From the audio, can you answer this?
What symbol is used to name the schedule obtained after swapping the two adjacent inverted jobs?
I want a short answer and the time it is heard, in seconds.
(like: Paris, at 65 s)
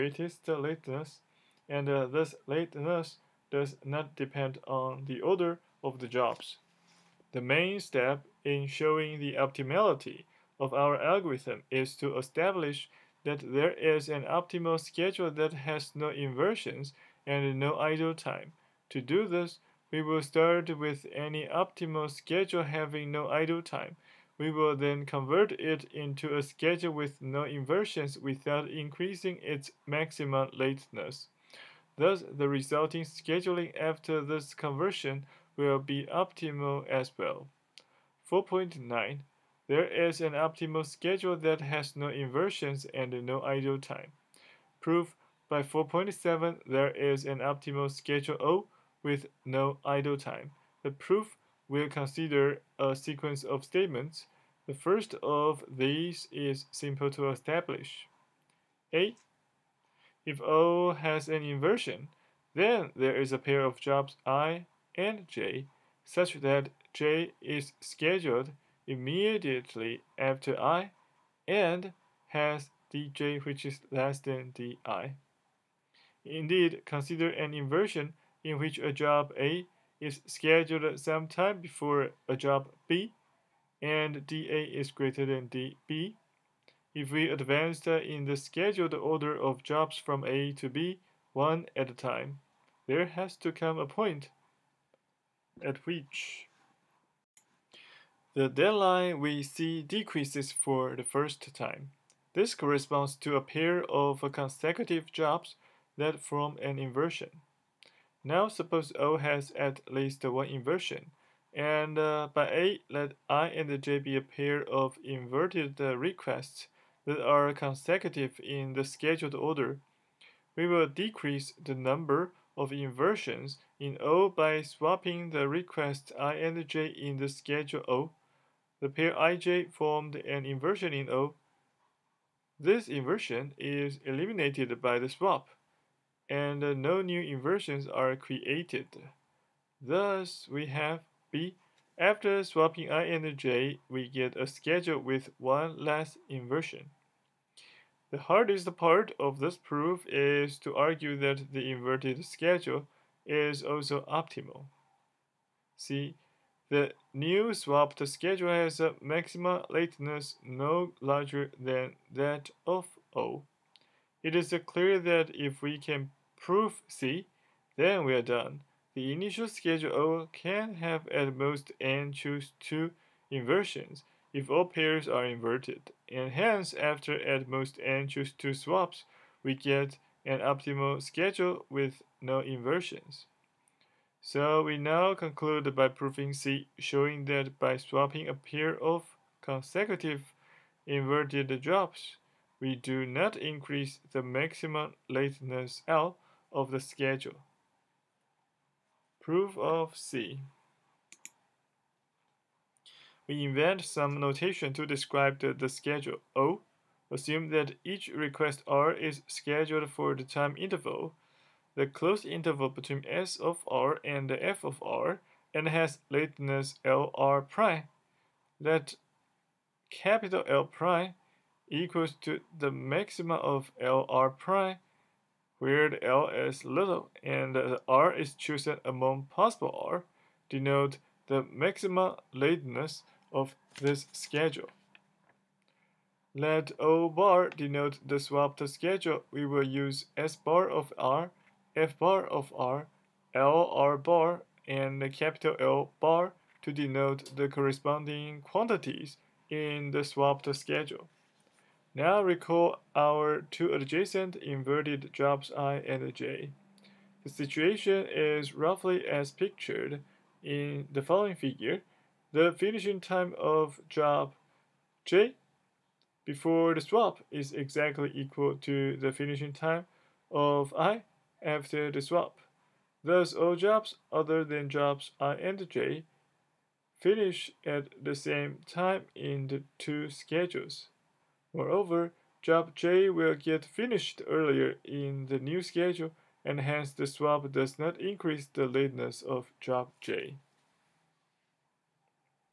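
O bar, at 236 s.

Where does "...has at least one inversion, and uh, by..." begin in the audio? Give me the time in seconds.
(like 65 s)
109 s.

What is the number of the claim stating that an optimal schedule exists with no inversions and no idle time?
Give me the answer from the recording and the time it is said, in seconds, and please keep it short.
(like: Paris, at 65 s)
4.9, at 38 s.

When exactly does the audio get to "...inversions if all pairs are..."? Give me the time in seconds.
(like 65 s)
173 s.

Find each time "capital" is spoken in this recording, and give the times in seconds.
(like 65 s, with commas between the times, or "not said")
219 s, 245 s.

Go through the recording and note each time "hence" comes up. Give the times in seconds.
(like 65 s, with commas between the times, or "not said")
176 s, 286 s.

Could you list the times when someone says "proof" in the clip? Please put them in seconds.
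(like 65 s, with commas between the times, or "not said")
44 s, 50 s, 149 s, 166 s, 199 s.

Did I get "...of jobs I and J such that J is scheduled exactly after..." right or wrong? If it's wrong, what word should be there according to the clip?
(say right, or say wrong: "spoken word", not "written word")
wrong: "immediately", not "exactly".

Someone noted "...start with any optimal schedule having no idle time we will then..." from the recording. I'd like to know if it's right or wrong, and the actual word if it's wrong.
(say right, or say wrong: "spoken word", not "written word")
right.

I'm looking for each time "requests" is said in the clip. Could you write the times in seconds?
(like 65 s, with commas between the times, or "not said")
115 s, 125 s, 208 s.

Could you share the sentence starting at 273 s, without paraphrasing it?
Thus, all jobs other than jobs i and j finish at the same time in the two schedules.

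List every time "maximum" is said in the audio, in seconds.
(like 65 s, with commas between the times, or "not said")
29 s, 159 s, 194 s, 222 s, 231 s.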